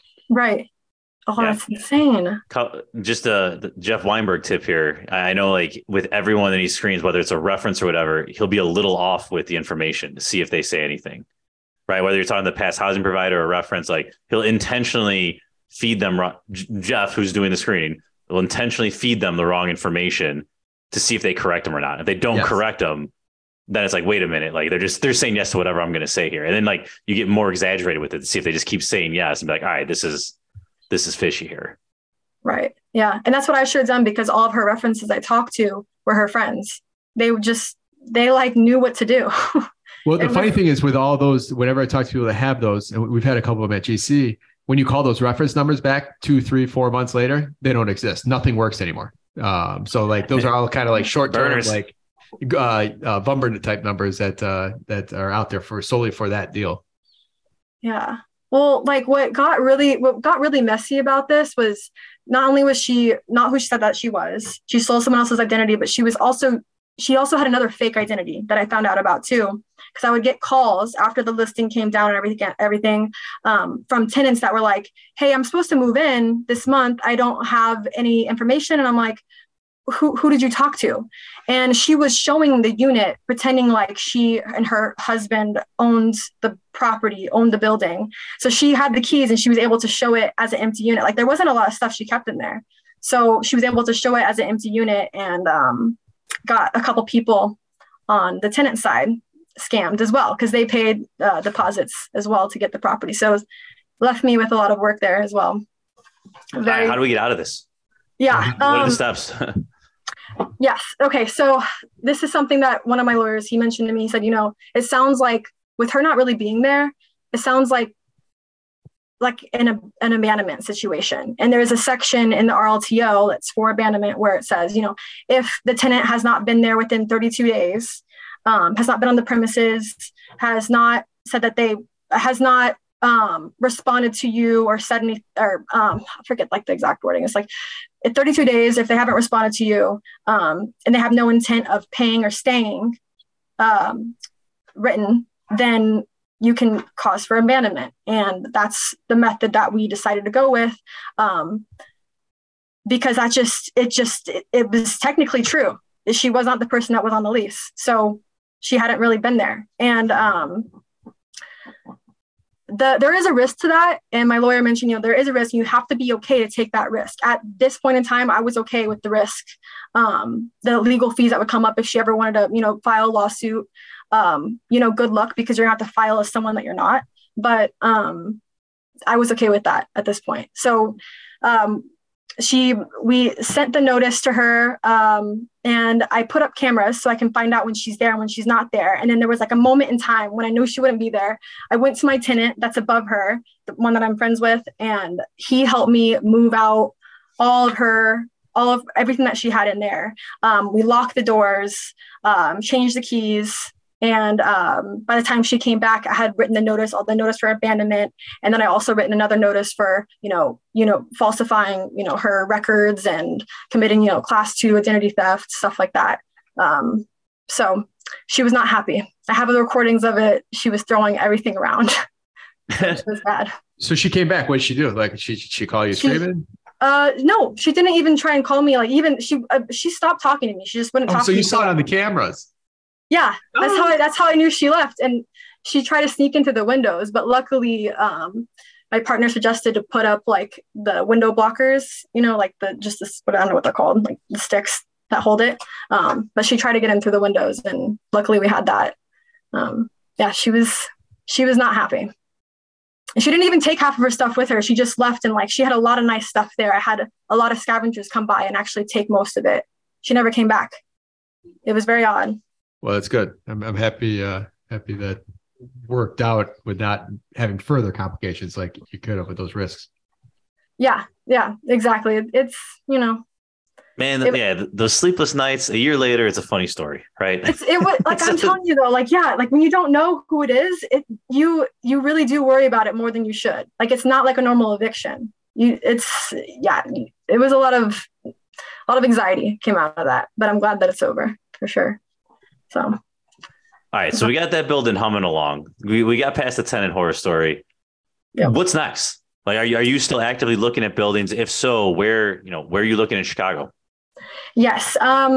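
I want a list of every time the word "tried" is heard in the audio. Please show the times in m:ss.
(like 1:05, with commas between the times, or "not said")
3:55, 4:06.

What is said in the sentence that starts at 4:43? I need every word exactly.
Like it's not like a normal eviction.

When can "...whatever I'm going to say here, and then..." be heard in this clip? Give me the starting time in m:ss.
0:25.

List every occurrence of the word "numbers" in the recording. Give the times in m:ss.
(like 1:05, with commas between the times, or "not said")
0:45, 0:53.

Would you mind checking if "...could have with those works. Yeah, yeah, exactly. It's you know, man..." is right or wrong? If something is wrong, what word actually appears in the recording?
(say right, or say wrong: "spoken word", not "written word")
wrong: "risks", not "works".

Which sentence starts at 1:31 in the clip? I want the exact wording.
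Like there wasn't a lot of stuff she kept in there.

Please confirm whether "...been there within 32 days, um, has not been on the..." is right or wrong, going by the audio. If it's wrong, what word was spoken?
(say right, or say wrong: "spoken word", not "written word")
right.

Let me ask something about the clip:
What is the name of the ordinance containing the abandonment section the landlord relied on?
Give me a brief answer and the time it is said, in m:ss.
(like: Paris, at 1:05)
RLTO, at 2:02.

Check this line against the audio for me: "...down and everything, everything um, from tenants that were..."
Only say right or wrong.
right.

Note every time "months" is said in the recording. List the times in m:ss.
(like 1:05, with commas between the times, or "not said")
0:46, 1:16.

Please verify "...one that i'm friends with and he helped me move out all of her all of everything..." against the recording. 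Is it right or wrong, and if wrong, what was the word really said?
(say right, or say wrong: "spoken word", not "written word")
right.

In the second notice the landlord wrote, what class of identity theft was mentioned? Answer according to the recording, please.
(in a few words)
class two.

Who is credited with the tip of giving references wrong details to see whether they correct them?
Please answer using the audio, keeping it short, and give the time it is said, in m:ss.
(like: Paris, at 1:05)
Jeff Weinberg, at 0:03.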